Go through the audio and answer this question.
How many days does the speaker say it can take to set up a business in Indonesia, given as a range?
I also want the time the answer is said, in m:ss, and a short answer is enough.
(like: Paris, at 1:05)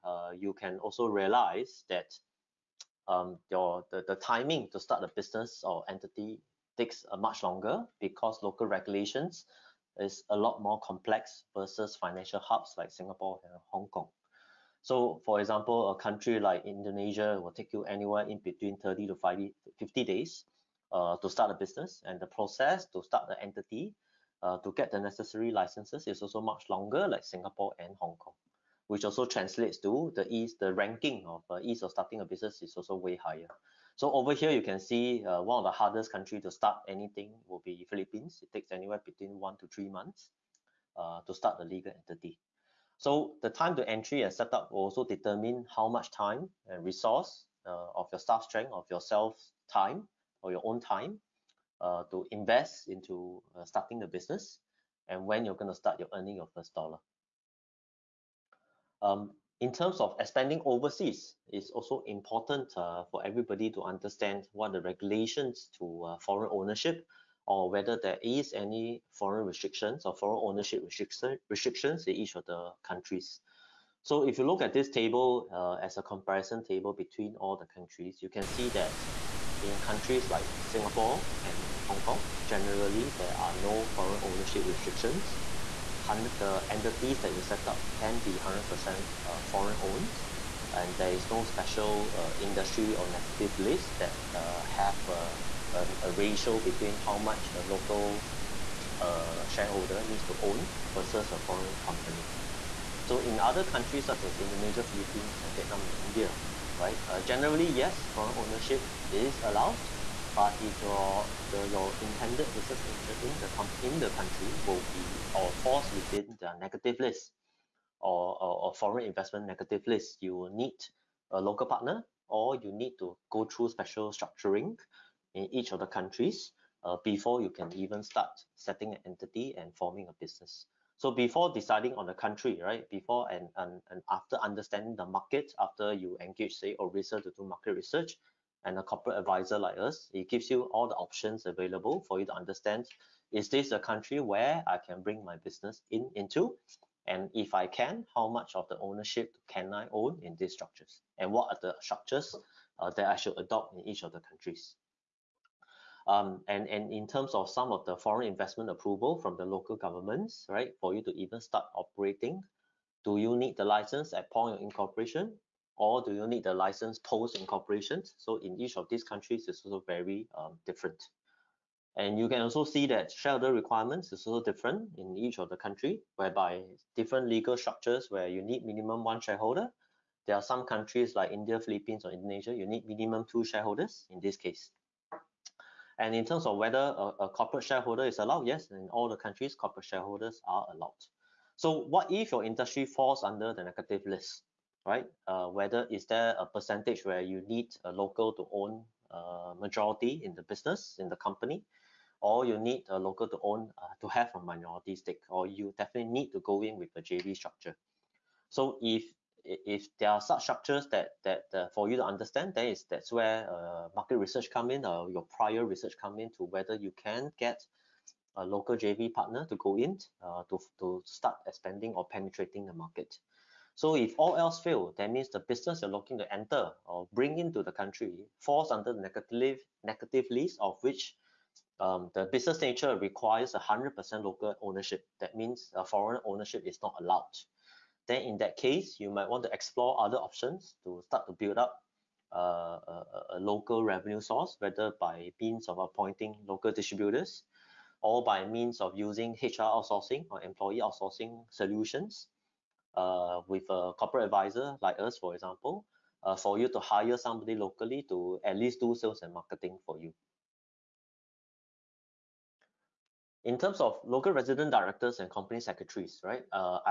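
30 to 50 days, at 0:18.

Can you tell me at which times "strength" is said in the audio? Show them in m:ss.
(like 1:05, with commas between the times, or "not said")
0:48.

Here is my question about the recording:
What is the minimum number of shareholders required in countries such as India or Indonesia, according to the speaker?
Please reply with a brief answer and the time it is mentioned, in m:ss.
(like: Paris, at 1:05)
2, at 3:03.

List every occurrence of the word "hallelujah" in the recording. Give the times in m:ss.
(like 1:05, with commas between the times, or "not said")
not said.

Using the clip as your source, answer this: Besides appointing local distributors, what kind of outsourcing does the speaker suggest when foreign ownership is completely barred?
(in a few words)
HR outsourcing.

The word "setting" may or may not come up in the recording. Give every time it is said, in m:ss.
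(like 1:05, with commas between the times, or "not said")
2:08.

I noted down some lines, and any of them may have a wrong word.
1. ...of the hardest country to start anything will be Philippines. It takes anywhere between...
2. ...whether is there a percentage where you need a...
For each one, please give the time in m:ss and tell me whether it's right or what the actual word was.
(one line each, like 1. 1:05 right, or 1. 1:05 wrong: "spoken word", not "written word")
1. 0:35 right
2. 3:15 right.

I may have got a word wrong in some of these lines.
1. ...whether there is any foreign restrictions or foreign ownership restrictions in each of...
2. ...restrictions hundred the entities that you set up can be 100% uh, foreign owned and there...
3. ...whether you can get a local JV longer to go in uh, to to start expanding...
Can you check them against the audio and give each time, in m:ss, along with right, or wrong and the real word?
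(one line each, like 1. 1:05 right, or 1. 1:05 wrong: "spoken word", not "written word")
1. 1:07 right
2. 1:24 right
3. 3:36 wrong: "partner", not "longer".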